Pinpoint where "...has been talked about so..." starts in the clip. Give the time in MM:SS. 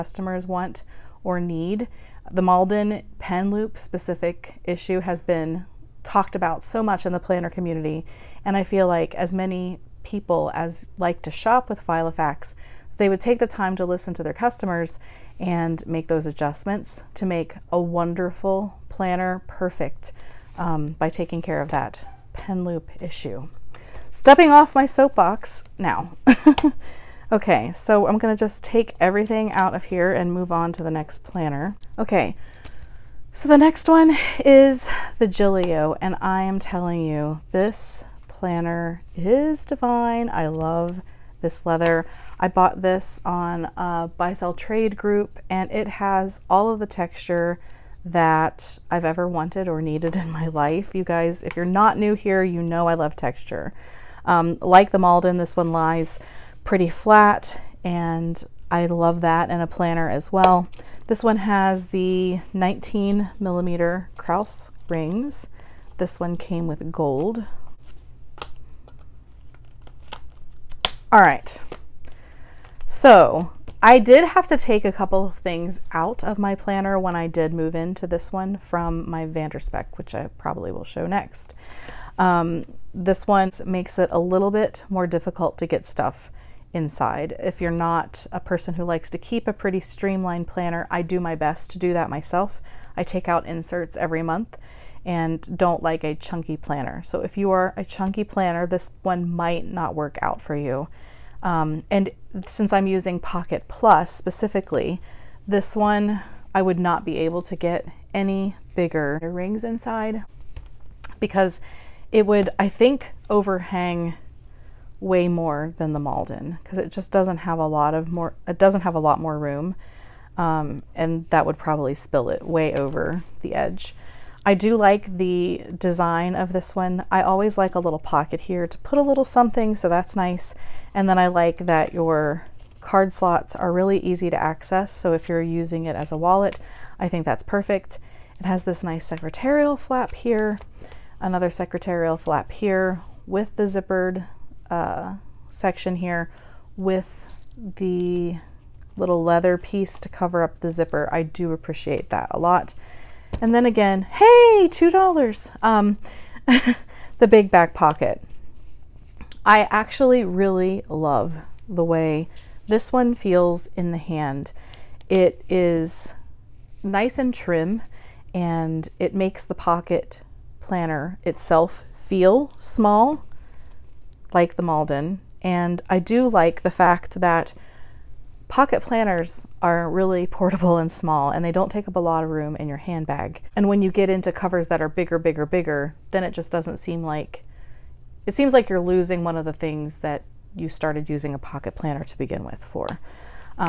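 00:05.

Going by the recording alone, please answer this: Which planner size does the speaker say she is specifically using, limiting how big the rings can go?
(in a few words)
Pocket Plus.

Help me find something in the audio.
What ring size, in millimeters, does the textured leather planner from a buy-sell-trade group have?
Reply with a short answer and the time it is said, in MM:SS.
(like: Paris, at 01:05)
19 millimeter, at 01:02.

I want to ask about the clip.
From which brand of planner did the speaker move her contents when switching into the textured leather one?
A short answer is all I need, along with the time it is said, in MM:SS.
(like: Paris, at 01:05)
Van der Spek, at 01:19.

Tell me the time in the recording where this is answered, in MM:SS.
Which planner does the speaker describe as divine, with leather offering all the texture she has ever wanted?
00:35.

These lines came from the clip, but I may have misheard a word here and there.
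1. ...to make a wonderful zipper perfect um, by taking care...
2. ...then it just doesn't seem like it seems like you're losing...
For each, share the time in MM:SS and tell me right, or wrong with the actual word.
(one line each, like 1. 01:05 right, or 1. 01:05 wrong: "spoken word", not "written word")
1. 00:17 wrong: "planner", not "zipper"
2. 03:06 right.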